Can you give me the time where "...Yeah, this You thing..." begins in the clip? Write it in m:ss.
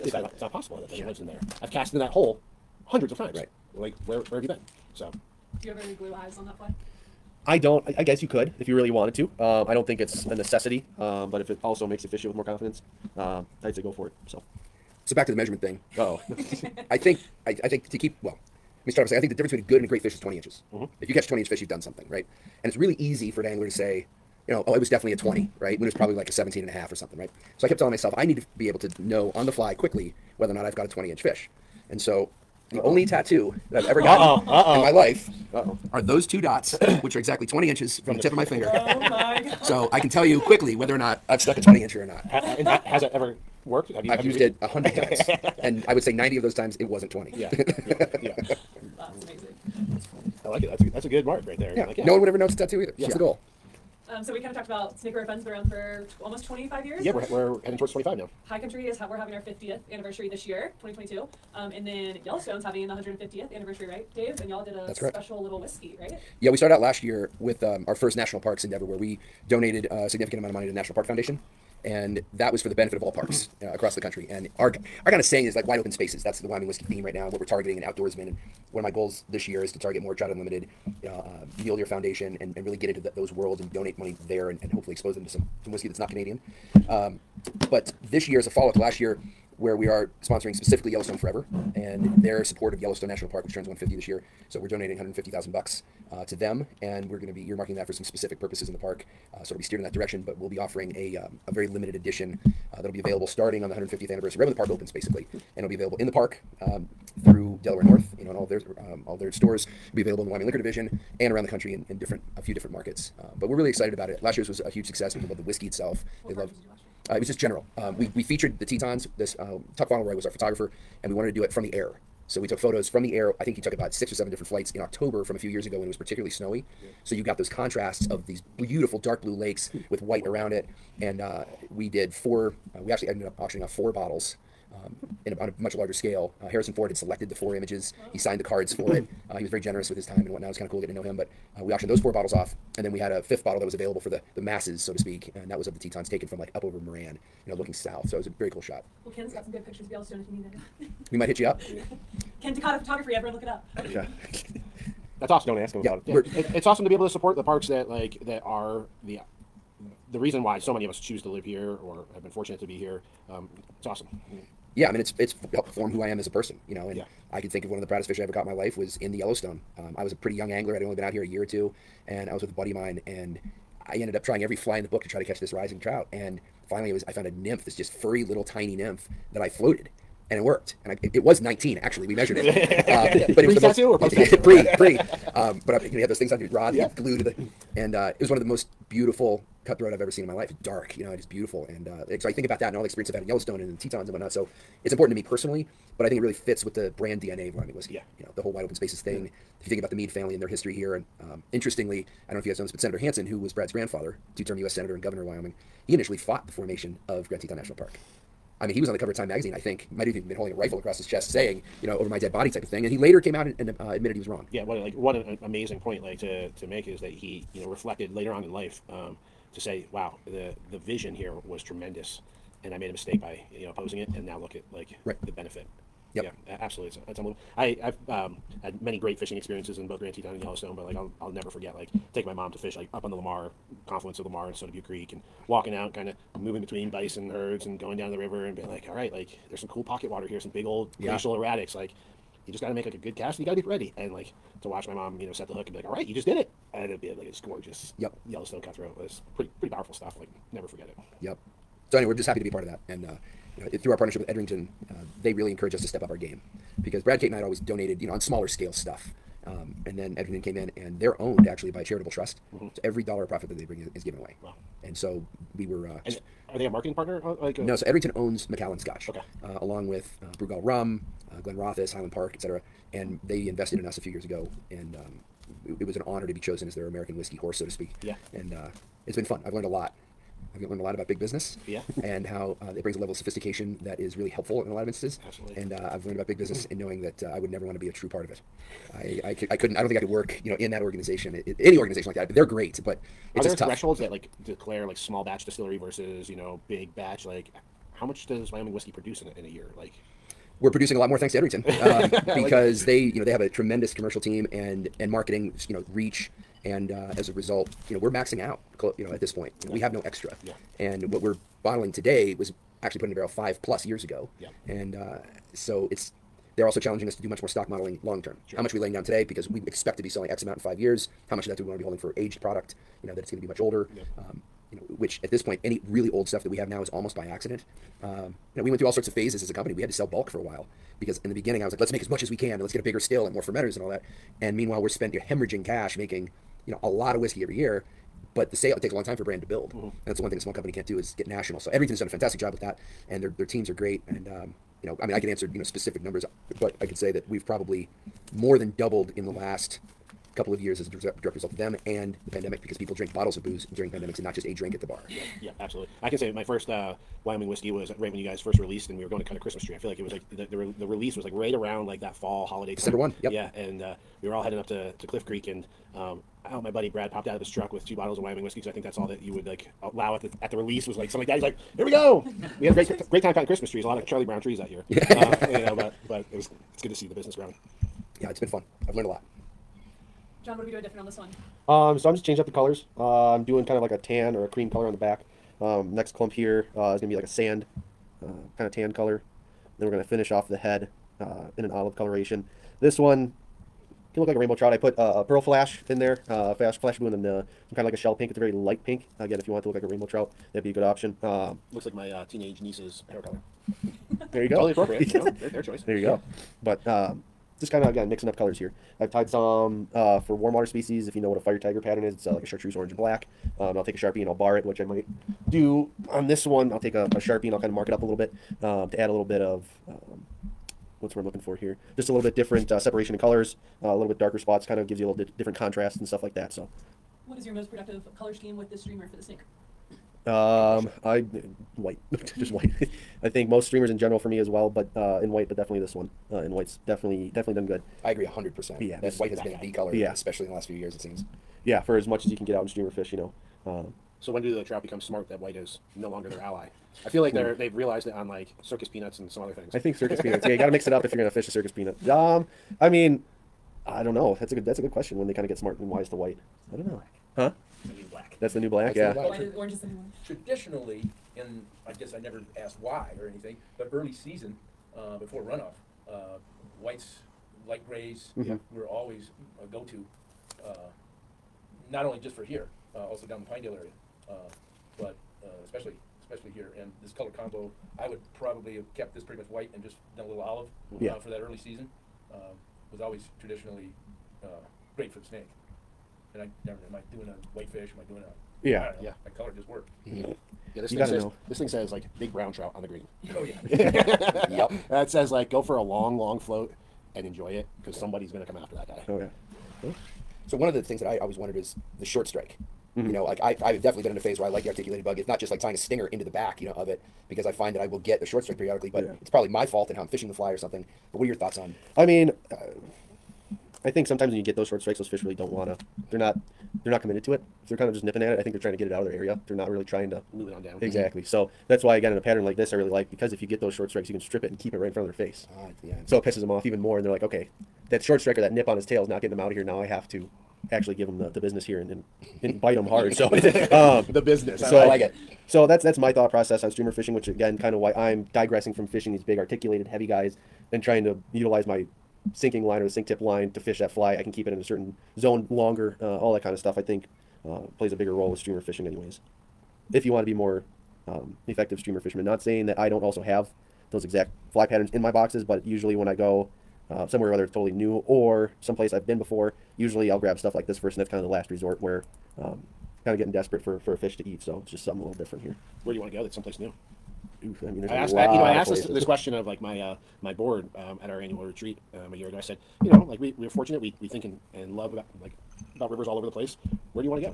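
8:10.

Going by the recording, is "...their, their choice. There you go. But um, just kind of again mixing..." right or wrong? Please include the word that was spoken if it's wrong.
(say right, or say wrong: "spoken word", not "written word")
right.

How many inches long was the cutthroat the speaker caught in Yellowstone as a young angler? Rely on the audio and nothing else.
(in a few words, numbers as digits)
19.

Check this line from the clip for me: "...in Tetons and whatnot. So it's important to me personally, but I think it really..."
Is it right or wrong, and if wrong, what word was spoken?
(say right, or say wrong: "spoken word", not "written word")
right.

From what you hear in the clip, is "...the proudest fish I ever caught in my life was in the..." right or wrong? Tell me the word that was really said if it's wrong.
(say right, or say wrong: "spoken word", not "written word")
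right.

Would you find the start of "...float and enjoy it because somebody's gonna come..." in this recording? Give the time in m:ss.
8:16.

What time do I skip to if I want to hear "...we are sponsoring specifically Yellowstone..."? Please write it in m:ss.
1:29.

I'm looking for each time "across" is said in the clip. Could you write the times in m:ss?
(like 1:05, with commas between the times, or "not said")
1:13, 3:30.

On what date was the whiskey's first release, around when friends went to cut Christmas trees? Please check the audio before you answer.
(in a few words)
December 1.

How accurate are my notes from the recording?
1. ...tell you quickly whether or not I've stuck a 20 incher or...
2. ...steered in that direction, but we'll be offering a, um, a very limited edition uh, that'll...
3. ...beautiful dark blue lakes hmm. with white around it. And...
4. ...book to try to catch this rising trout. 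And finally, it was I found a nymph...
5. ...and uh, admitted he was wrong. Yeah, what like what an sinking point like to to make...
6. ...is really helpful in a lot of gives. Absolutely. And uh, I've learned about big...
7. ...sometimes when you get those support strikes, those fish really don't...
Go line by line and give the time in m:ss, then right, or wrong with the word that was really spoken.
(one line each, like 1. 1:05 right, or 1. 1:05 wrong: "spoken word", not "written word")
1. 0:40 right
2. 1:39 right
3. 2:08 right
4. 2:54 right
5. 3:33 wrong: "amazing", not "sinking"
6. 4:43 wrong: "instances", not "gives"
7. 8:34 wrong: "short", not "support".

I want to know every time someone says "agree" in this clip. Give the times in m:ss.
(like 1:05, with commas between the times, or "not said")
7:18.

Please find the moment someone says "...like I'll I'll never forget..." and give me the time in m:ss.
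3:50.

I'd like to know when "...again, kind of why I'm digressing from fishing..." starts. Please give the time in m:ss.
8:57.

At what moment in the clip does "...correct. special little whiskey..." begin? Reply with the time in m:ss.
1:04.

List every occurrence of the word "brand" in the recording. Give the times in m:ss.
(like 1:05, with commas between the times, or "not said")
3:16, 5:39.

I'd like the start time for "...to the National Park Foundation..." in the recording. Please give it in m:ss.
1:10.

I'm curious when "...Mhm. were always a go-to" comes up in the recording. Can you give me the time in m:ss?
7:48.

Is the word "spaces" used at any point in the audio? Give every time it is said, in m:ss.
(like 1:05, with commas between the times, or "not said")
1:15, 3:18.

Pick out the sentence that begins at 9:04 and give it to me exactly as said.
I can keep it in a certain zone longer, uh, all that kind of stuff.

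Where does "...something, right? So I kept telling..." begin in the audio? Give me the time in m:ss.
0:26.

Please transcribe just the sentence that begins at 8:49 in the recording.
Now I have to actually give them the, the business here and, and, and bite them hard.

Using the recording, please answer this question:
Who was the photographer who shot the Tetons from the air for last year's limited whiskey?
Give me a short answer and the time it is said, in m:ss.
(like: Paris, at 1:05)
Tuck Fauntleroy, at 1:59.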